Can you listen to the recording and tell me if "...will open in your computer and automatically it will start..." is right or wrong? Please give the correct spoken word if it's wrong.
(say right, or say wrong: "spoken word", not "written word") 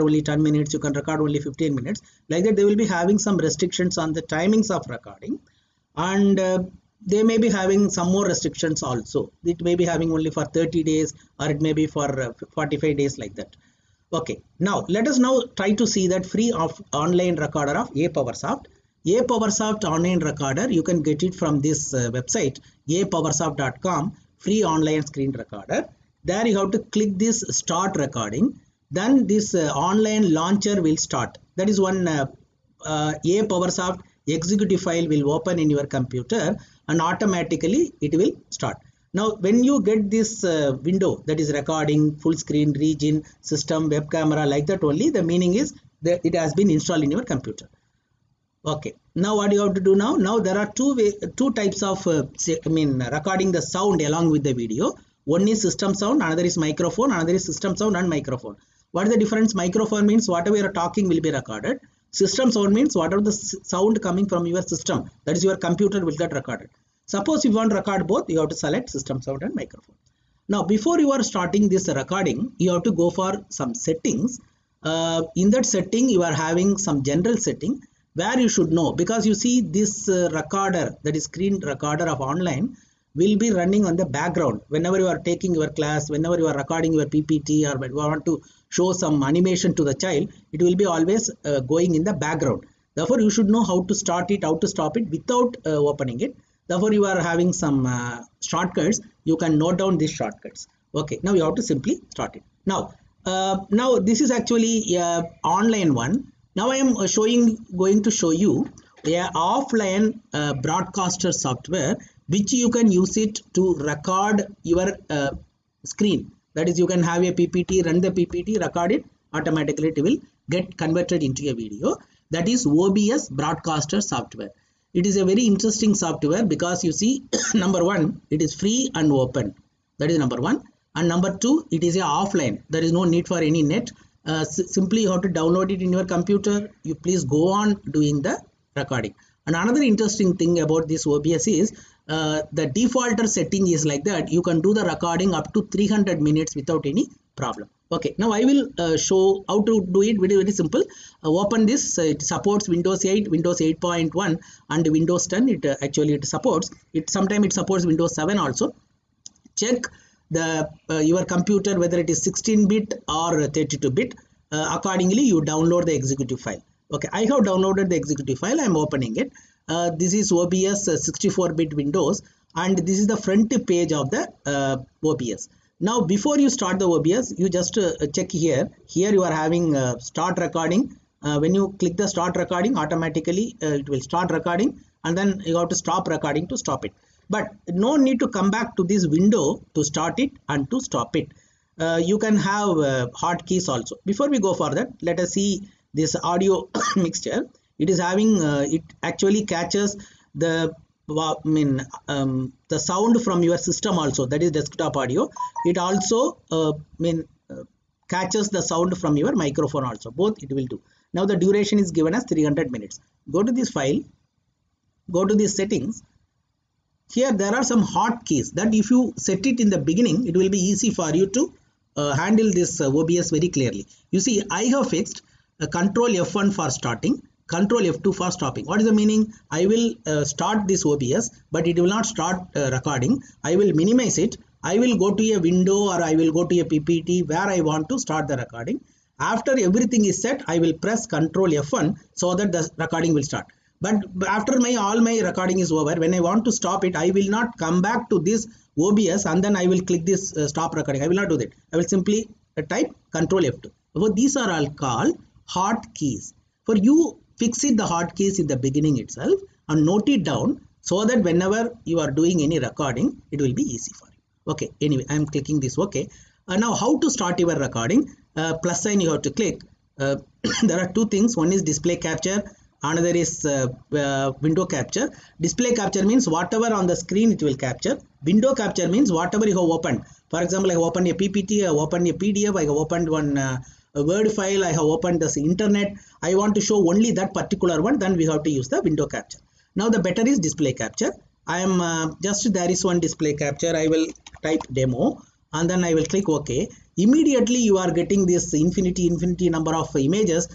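right.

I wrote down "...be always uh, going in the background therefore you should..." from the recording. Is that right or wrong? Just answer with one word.
right.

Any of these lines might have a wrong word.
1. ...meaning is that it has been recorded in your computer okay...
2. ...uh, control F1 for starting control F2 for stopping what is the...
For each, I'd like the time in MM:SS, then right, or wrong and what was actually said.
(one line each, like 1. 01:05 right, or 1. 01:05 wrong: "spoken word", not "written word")
1. 00:45 wrong: "installed", not "recorded"
2. 03:45 right.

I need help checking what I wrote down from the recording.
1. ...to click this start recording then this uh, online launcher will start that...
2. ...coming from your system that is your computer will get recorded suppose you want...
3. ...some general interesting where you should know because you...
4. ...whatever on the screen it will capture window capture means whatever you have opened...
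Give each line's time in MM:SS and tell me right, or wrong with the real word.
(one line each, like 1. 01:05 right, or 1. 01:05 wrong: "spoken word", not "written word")
1. 00:26 right
2. 01:04 right
3. 01:16 wrong: "setting", not "interesting"
4. 04:36 right.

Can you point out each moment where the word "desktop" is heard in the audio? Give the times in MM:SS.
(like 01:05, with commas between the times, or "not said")
03:24.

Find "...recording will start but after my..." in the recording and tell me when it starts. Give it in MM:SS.
04:02.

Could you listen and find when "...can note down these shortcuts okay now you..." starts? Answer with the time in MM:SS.
01:39.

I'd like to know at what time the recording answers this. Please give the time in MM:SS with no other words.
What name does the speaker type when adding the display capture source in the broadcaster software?
04:54.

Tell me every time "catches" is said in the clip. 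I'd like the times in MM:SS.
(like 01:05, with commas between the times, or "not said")
03:19, 03:28.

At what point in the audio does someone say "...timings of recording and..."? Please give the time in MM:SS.
00:04.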